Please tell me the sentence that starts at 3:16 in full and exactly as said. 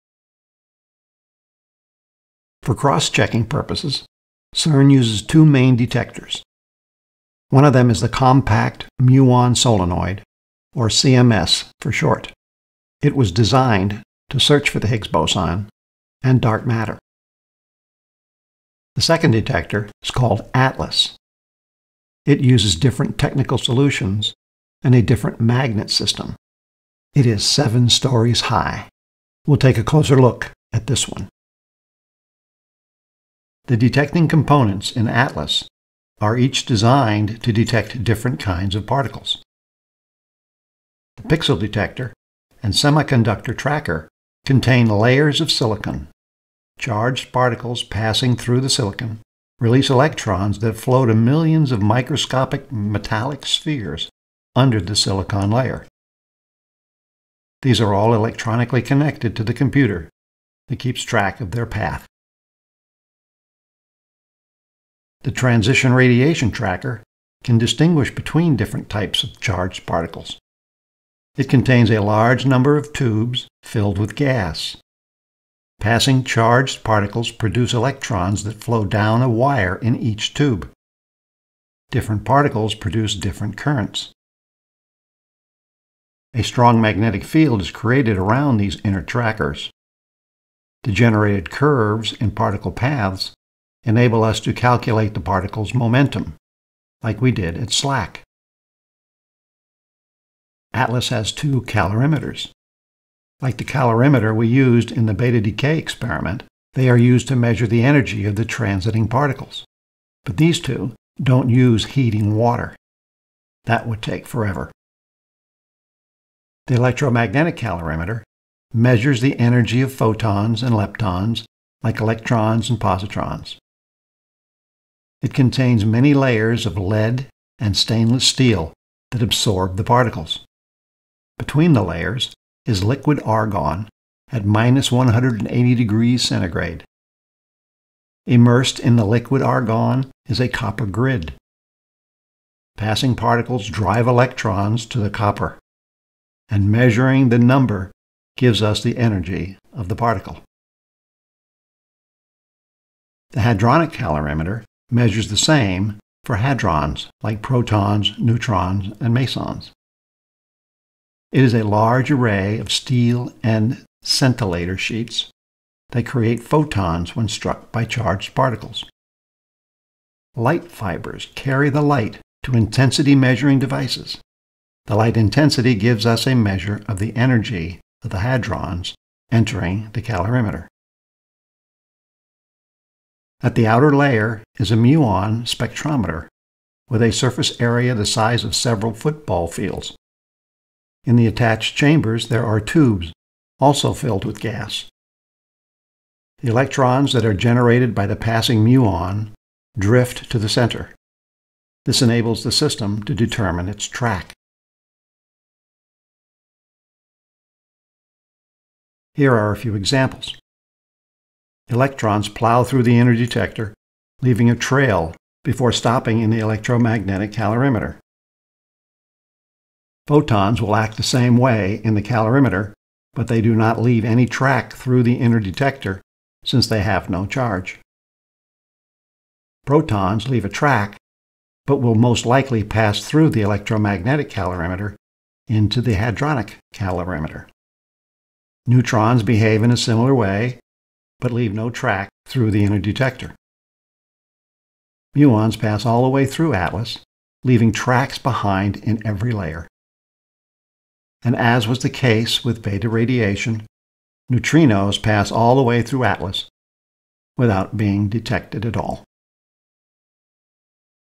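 The electrons that are generated by the passing muon drift to the center.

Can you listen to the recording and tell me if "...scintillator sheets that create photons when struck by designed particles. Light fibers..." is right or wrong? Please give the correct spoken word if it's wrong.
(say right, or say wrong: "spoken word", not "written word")
wrong: "charged", not "designed".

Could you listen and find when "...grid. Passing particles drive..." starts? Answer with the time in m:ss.
2:20.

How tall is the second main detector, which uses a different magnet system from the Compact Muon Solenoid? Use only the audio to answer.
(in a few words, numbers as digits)
7 stories.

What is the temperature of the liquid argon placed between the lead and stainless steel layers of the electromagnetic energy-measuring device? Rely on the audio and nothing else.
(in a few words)
-180 degrees centigrade.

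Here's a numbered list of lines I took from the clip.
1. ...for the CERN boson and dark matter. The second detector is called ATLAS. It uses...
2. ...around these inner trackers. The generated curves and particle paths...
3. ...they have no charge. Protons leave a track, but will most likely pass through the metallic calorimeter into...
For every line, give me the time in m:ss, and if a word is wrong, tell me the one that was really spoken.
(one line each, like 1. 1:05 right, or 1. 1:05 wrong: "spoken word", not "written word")
1. 0:14 wrong: "Higgs", not "CERN"
2. 1:28 right
3. 3:46 wrong: "electromagnetic", not "metallic".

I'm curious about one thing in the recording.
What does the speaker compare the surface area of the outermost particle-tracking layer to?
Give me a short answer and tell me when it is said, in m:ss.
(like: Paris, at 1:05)
several football fields, at 3:08.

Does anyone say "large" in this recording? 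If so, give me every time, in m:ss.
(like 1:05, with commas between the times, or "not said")
1:12, 2:41.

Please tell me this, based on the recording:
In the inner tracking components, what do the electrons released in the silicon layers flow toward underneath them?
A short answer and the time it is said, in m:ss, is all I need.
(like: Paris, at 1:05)
microscopic metallic spheres, at 0:51.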